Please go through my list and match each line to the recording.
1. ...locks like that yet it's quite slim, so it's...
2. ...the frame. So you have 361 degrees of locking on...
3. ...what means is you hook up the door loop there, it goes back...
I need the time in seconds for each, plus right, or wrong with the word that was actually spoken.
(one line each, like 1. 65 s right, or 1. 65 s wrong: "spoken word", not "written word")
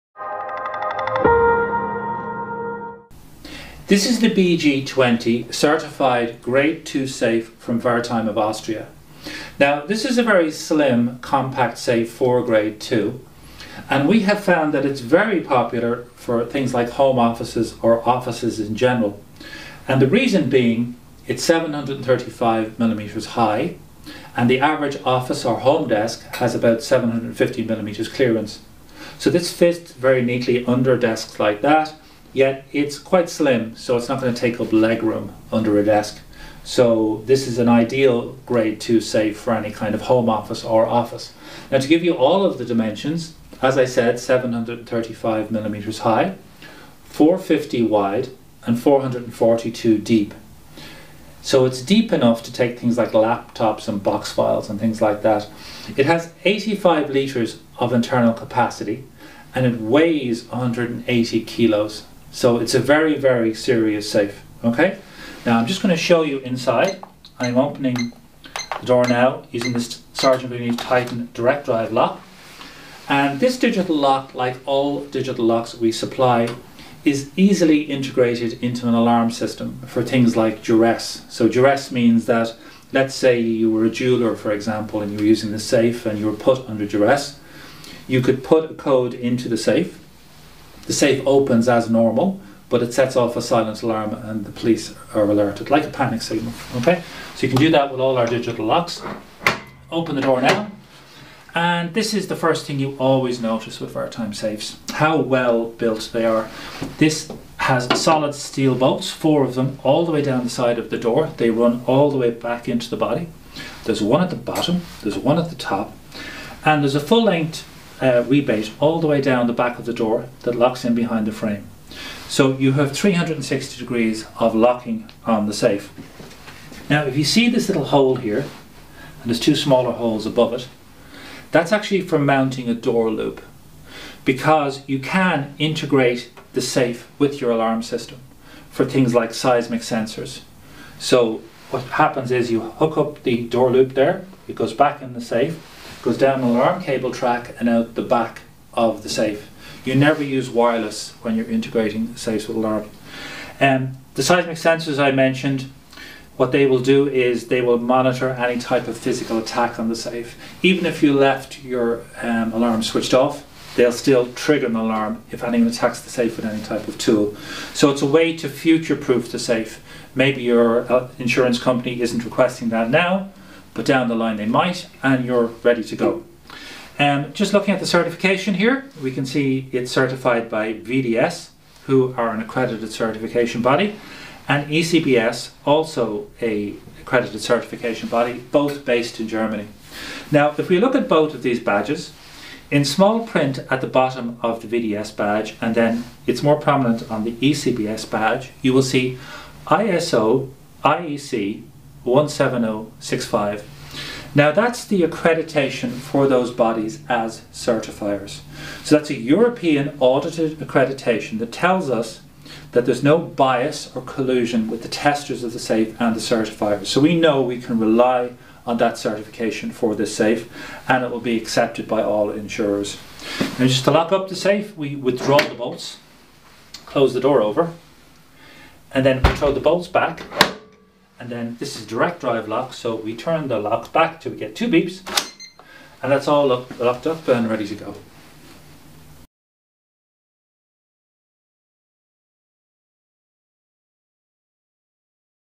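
1. 30 s wrong: "desks", not "locks"
2. 121 s wrong: "360", not "361"
3. 141 s wrong: "happens", not "means".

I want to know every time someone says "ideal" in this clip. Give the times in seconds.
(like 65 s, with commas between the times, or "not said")
37 s.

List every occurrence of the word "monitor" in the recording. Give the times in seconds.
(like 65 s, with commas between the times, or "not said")
157 s.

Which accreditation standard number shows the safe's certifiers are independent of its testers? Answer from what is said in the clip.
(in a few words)
ISO/IEC 17065.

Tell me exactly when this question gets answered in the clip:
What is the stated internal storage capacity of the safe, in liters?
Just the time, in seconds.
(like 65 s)
56 s.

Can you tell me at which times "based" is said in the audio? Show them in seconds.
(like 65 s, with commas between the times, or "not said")
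188 s.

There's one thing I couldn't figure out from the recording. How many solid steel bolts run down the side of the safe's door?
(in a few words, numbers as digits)
4.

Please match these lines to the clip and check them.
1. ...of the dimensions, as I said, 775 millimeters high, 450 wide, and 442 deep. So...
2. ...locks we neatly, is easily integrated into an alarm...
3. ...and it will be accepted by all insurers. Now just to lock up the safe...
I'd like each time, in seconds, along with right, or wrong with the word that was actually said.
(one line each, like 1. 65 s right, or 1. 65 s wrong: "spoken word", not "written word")
1. 42 s wrong: "735", not "775"
2. 75 s wrong: "supply", not "neatly"
3. 220 s right.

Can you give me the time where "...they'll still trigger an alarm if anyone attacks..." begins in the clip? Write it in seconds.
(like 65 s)
163 s.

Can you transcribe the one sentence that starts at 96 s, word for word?
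Okay, so you can do that with all our digital locks.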